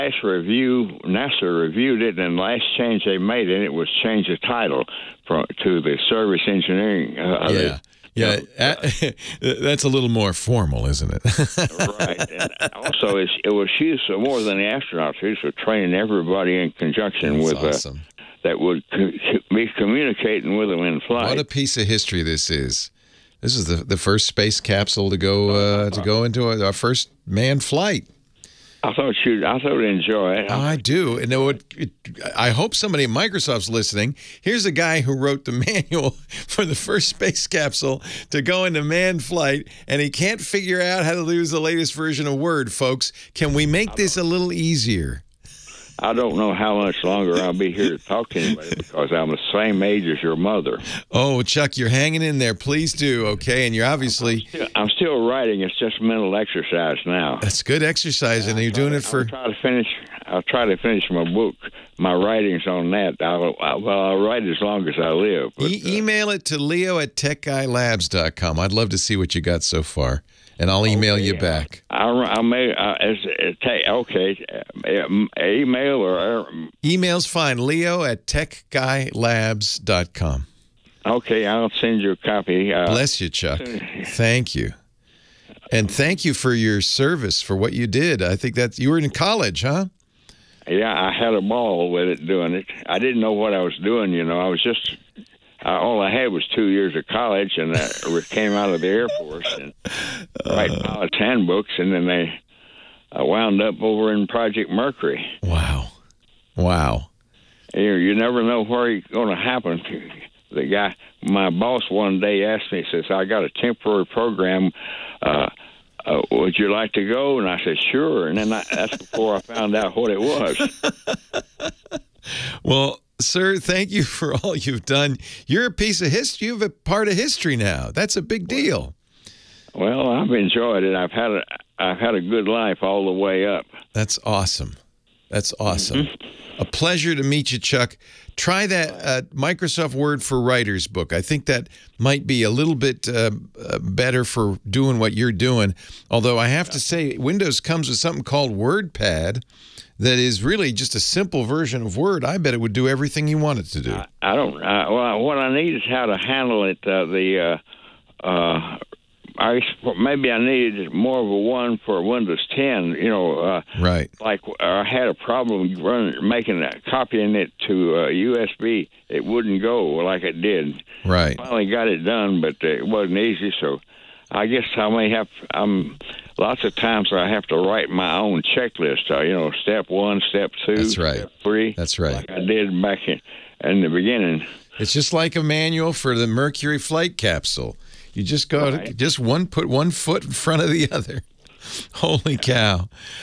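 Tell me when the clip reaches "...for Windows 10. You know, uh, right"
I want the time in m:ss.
2:41.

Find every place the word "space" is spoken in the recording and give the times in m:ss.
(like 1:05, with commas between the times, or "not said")
0:24, 0:37.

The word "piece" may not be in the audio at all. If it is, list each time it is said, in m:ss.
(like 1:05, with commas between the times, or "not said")
0:21, 2:05.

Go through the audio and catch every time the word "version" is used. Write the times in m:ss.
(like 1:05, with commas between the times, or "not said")
0:41, 2:31.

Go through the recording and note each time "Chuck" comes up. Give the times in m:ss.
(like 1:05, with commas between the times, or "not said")
0:51, 1:23, 2:17.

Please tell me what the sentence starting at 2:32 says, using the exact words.
I bet it would do everything you want it to do.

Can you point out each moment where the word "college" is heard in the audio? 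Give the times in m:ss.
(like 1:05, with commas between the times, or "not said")
1:29, 1:37.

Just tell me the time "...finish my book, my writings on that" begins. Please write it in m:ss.
1:00.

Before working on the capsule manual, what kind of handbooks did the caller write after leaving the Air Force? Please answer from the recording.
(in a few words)
Pilots' handbooks.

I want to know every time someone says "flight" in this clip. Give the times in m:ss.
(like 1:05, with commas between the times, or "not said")
0:21, 0:27, 0:39, 3:06.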